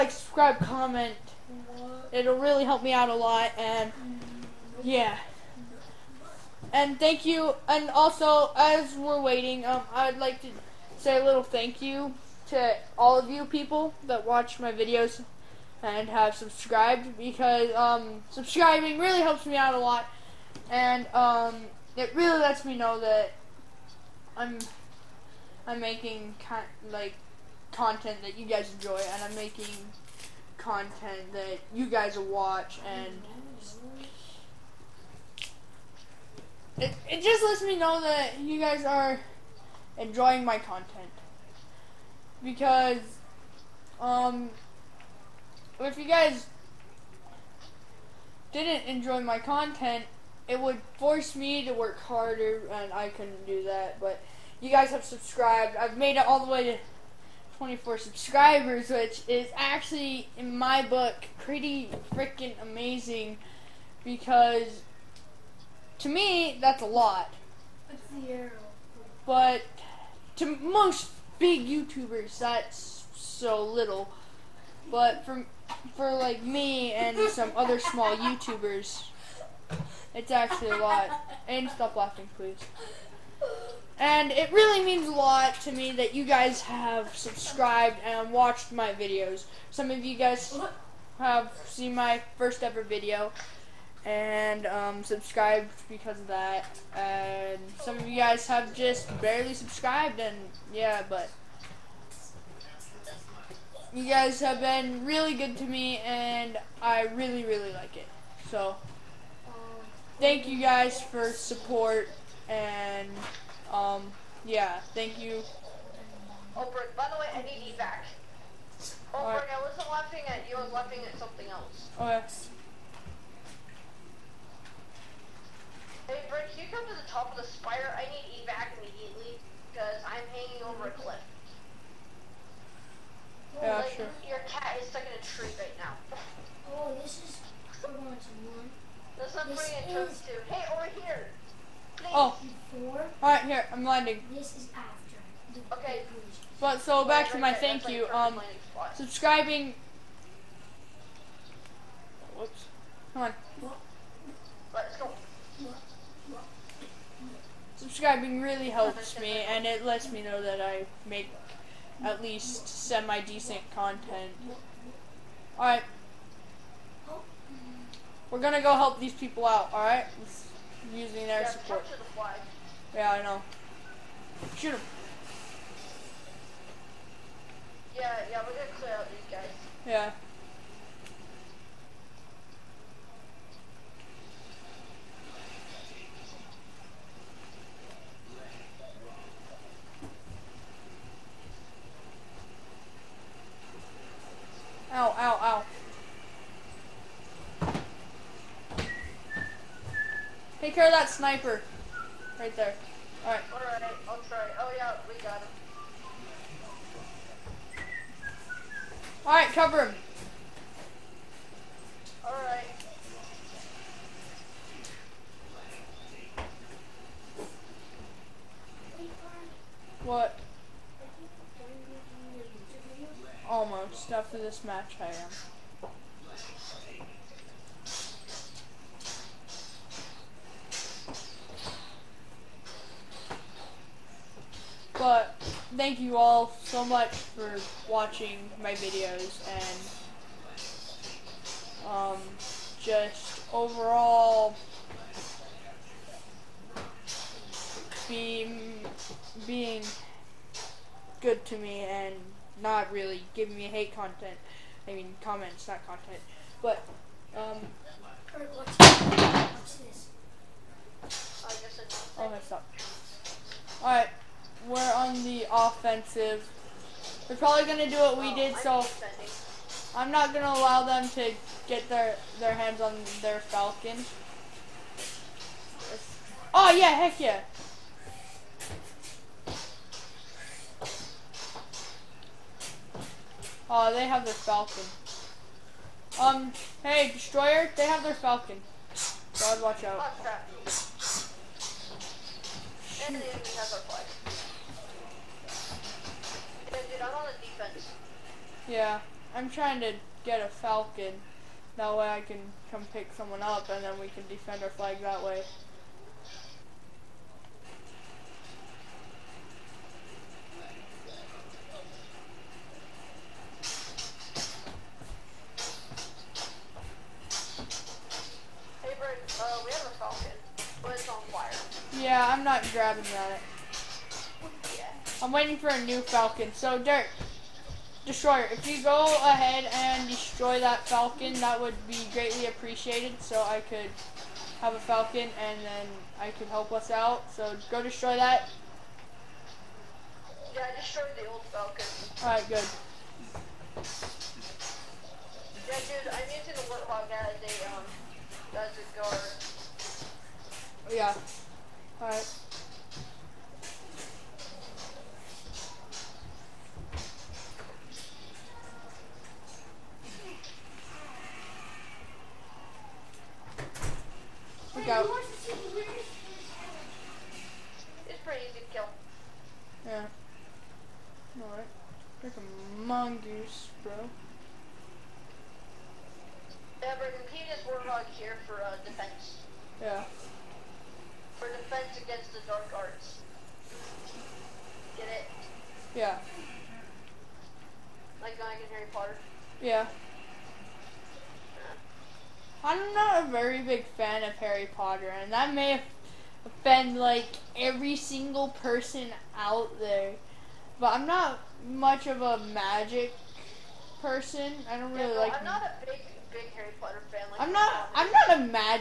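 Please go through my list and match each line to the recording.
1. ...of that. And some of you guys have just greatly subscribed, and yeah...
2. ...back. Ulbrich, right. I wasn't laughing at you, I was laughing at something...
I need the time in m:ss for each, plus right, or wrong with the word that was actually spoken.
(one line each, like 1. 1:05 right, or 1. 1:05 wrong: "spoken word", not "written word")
1. 1:36 wrong: "barely", not "greatly"
2. 1:57 right.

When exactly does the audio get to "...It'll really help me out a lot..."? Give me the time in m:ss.
0:02.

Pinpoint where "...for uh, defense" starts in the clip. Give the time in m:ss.
6:18.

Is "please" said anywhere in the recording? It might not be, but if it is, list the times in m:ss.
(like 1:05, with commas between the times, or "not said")
1:22.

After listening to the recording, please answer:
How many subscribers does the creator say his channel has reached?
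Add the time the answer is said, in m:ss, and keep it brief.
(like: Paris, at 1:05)
24, at 0:57.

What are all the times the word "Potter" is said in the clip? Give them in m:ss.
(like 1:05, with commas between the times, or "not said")
6:28, 6:34, 6:46.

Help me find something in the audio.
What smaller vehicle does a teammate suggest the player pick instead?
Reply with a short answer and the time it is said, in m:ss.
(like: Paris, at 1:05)
mongoose, at 6:12.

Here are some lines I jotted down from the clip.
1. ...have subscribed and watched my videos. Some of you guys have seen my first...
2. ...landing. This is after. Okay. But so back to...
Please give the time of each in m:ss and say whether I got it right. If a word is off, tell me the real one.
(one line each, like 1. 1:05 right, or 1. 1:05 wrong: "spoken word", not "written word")
1. 1:26 right
2. 2:23 right.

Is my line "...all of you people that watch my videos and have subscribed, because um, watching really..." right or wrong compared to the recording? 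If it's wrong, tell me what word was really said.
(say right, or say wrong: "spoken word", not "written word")
wrong: "subscribing", not "watching".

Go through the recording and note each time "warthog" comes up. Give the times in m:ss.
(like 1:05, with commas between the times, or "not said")
5:46, 6:17.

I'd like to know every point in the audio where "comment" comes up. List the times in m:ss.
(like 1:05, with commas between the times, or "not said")
0:00, 4:15.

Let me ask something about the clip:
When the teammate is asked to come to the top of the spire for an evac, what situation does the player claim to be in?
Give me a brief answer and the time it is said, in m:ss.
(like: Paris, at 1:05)
hanging over a cliff, at 2:10.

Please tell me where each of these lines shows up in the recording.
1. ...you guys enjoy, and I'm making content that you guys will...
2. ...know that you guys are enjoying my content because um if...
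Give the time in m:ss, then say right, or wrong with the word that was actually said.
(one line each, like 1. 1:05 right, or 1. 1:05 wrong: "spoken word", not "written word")
1. 0:28 right
2. 0:37 right.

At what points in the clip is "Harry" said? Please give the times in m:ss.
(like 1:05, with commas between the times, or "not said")
6:28, 6:34, 6:46.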